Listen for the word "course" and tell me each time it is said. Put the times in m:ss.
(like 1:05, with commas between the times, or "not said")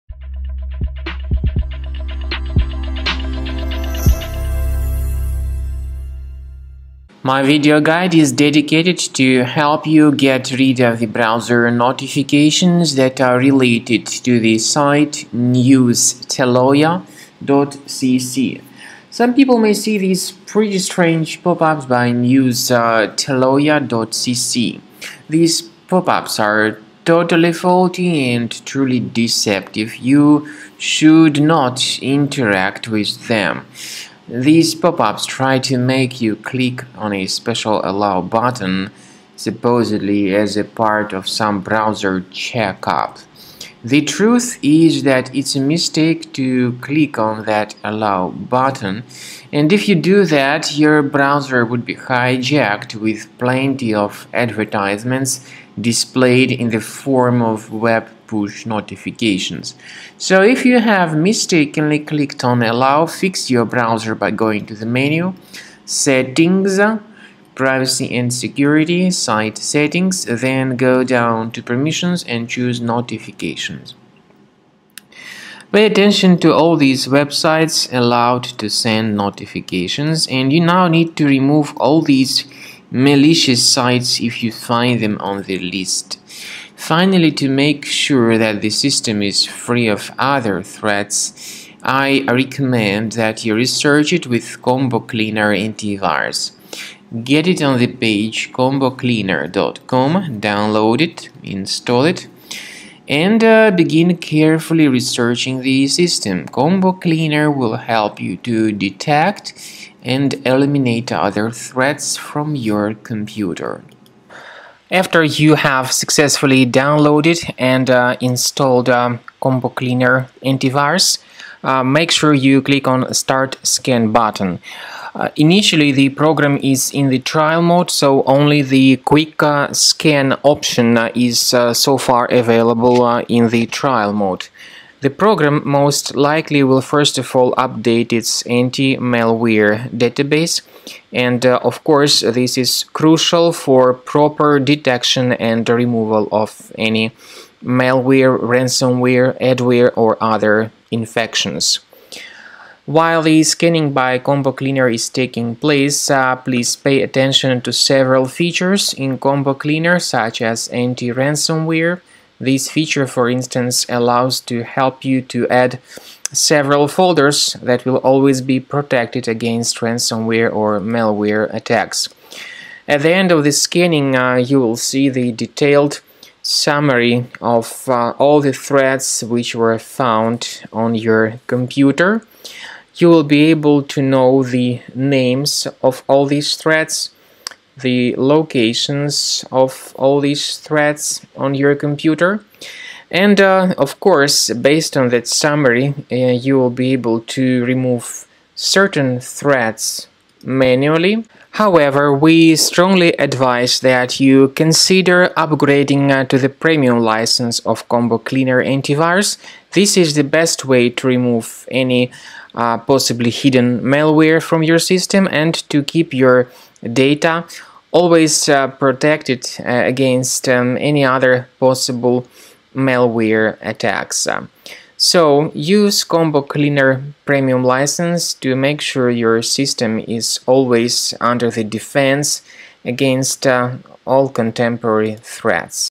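2:21, 3:13.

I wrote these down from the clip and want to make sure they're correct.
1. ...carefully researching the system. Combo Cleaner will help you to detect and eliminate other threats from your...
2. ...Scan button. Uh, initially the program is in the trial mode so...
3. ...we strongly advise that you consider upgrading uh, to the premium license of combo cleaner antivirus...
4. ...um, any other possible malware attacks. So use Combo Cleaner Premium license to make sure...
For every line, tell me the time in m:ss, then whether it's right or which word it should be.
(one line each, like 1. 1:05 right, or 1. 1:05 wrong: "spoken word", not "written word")
1. 1:44 right
2. 2:03 right
3. 3:22 right
4. 3:40 right.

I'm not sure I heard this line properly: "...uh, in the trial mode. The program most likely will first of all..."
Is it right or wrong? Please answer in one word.
right.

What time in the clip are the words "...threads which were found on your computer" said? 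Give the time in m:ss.
2:58.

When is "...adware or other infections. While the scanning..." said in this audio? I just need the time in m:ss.
2:29.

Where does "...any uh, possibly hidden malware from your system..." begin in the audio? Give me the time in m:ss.
3:31.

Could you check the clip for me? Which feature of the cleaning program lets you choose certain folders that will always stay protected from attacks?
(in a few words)
Anti-ransomware.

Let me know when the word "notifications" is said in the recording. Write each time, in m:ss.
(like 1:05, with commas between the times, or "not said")
0:11, 0:58, 1:12, 1:19.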